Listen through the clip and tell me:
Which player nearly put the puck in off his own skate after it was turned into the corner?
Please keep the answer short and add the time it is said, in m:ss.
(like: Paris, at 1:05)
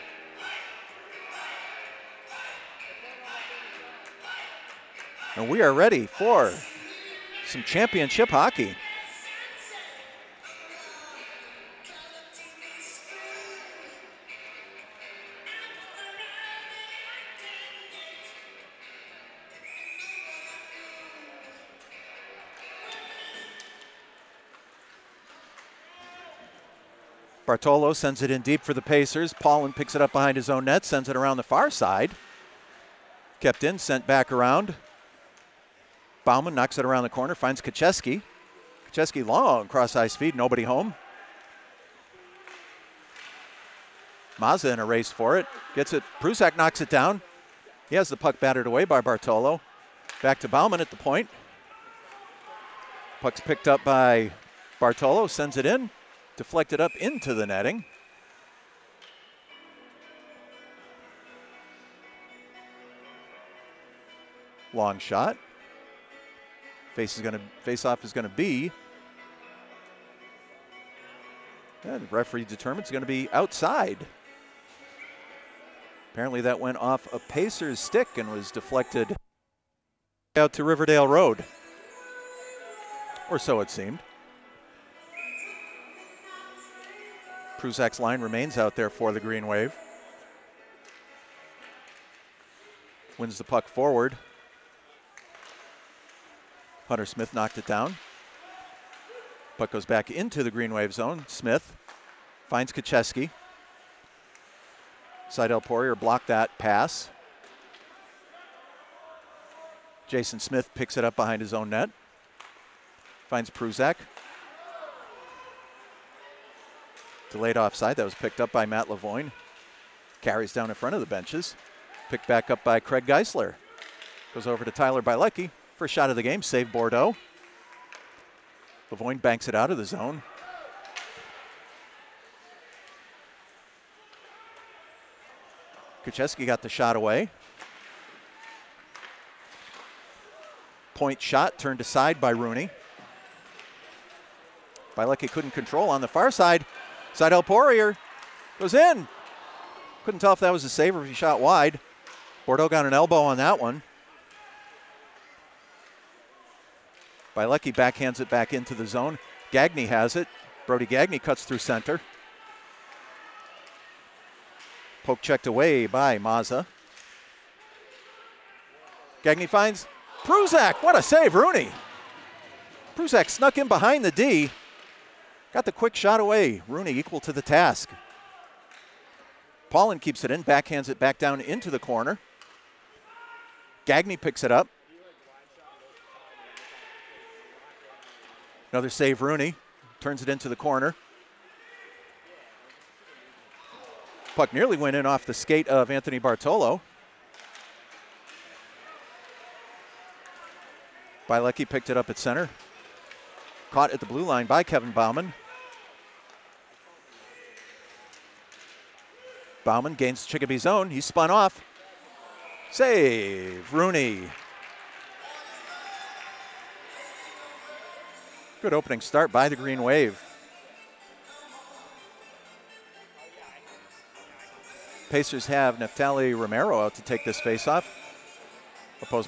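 Anthony Bartolo, at 3:15.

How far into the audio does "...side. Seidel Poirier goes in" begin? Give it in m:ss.
2:26.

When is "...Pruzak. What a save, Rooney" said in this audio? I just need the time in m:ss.
2:50.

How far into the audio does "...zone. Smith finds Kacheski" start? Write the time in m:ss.
1:40.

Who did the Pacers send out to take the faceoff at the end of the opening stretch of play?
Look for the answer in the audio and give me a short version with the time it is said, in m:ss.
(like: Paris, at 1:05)
Neftali Romero, at 3:45.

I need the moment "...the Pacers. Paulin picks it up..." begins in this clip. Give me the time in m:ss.
0:28.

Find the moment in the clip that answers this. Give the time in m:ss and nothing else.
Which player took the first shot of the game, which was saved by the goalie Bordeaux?
2:04.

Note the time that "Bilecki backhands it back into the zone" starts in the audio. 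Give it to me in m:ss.
2:37.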